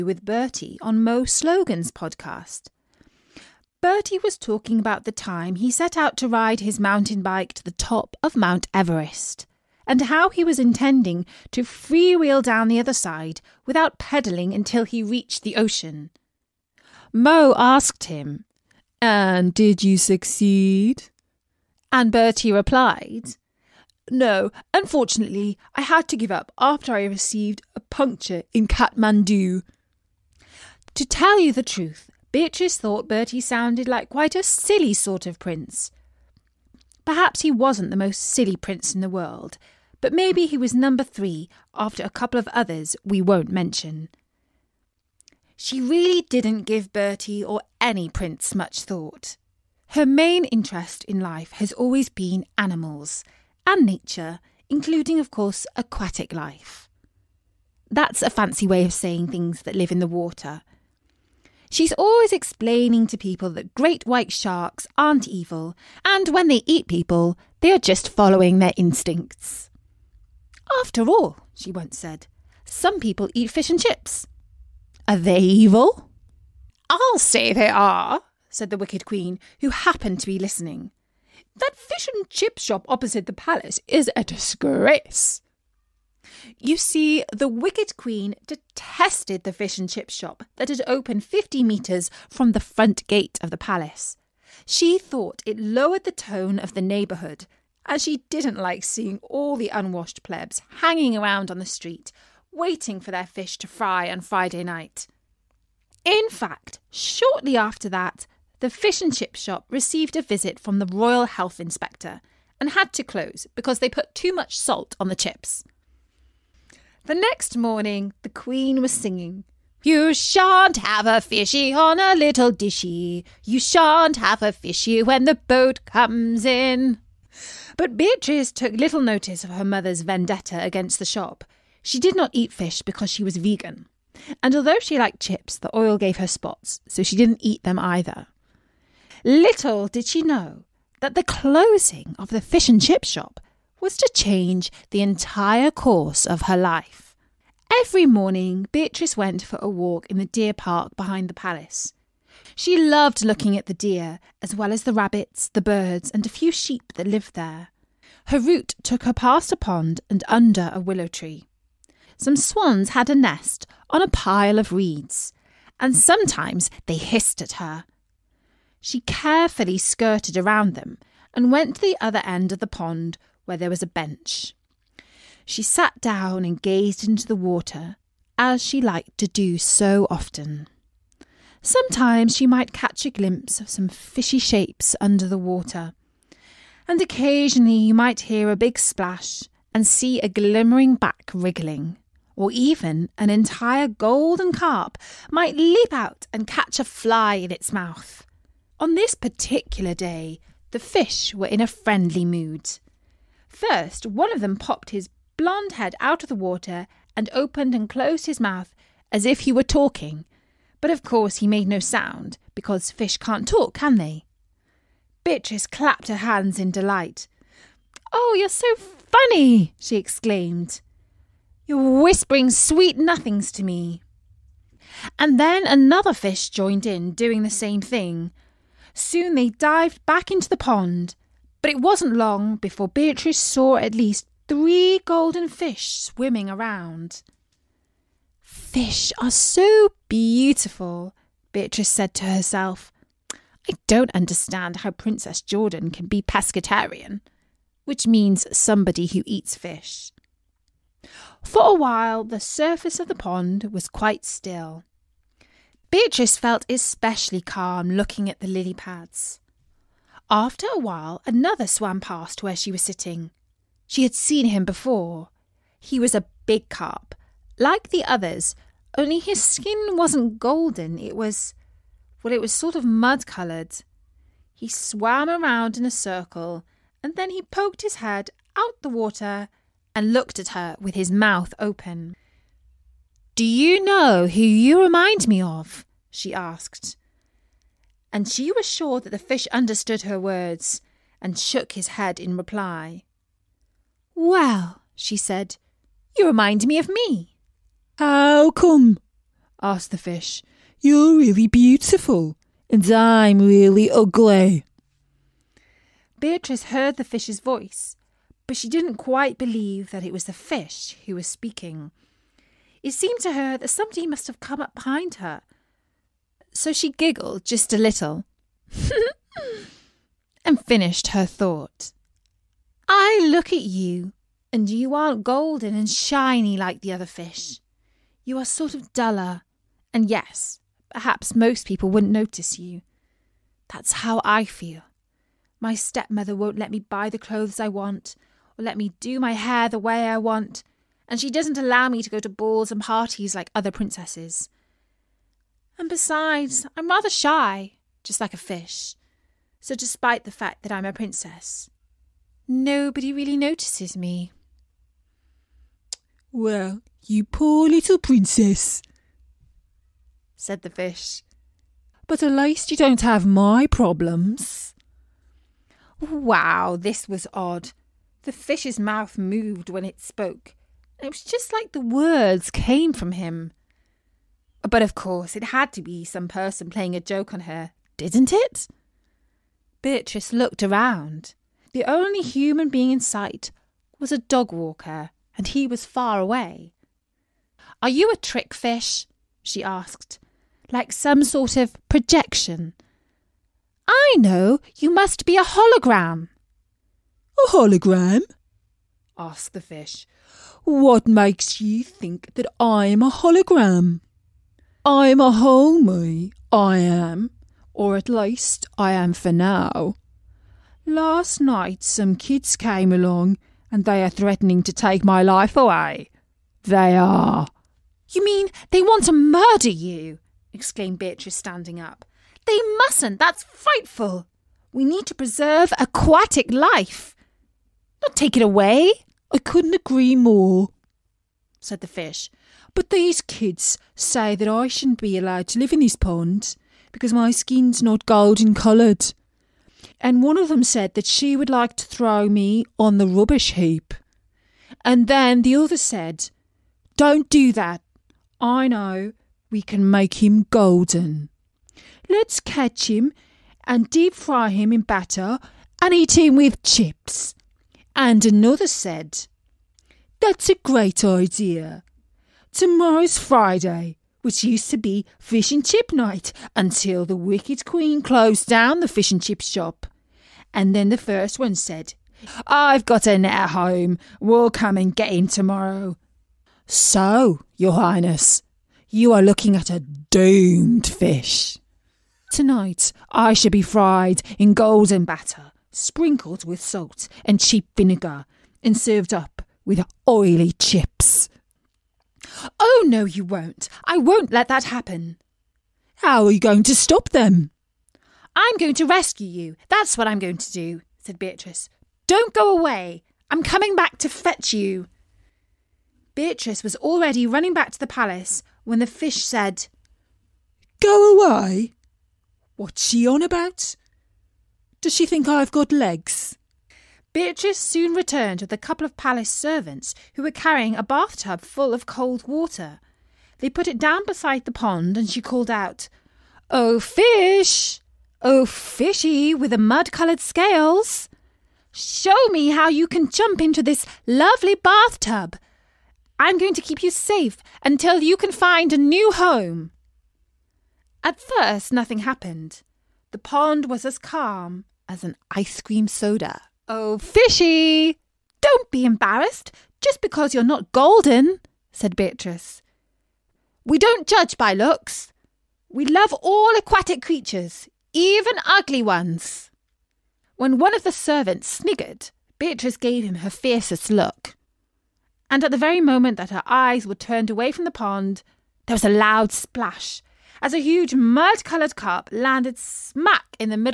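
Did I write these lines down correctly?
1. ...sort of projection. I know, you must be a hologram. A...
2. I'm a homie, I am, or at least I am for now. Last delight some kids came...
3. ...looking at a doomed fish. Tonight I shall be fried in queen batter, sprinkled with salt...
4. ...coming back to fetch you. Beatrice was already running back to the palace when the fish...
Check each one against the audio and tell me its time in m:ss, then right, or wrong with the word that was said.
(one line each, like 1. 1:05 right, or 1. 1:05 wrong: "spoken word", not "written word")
1. 6:31 right
2. 6:44 wrong: "night", not "delight"
3. 7:59 wrong: "golden", not "queen"
4. 8:23 right.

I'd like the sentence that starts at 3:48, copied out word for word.
Soon they dived back into the pond, but it wasn't long before Beatrice saw at least three golden fish swimming around.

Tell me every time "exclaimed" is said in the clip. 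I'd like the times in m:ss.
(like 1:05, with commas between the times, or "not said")
3:39, 7:00.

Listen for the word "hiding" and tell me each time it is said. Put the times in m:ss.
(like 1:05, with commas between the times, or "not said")
not said.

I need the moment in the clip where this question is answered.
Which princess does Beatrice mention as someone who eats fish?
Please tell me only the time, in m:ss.
4:04.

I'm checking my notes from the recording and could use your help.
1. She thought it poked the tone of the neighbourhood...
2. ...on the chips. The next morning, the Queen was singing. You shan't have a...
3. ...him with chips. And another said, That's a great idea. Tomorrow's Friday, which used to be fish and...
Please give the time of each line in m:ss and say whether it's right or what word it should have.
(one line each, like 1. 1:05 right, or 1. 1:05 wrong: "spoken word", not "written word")
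1. 1:34 wrong: "lowered", not "poked"
2. 1:55 right
3. 7:36 right.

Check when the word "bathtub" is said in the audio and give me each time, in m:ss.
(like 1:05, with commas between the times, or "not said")
8:40, 8:54.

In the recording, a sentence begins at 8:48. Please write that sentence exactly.
Oh, fishy with the mud coloured scales!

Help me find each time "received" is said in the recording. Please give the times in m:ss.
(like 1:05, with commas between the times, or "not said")
0:27, 1:49.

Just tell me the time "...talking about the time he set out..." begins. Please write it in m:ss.
0:04.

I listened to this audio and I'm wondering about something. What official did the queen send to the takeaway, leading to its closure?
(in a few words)
Royal Health Inspector.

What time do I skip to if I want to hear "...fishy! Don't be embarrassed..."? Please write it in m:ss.
9:06.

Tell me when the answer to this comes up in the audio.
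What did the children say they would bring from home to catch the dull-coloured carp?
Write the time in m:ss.
7:53.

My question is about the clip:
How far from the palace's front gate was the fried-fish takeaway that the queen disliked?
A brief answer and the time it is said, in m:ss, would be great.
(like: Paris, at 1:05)
50 metres, at 1:31.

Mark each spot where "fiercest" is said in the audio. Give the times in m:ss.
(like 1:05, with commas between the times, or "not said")
9:23.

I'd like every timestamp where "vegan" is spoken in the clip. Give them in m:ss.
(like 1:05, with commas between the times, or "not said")
2:13.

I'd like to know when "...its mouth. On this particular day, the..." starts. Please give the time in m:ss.
3:17.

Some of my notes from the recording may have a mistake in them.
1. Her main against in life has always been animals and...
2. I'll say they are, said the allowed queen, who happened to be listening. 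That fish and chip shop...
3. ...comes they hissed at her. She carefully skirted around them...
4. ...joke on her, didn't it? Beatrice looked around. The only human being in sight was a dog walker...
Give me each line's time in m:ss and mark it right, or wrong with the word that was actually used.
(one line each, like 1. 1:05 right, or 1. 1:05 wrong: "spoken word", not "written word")
1. 0:49 wrong: "interest", not "against"
2. 1:16 wrong: "wicked", not "allowed"
3. 2:45 wrong: "sometimes", not "comes"
4. 6:17 right.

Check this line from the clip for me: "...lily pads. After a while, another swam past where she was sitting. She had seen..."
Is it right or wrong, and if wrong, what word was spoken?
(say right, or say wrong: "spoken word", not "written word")
right.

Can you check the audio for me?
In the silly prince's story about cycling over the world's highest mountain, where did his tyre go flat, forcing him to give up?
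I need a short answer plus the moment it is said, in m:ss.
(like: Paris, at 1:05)
Kathmandu, at 0:28.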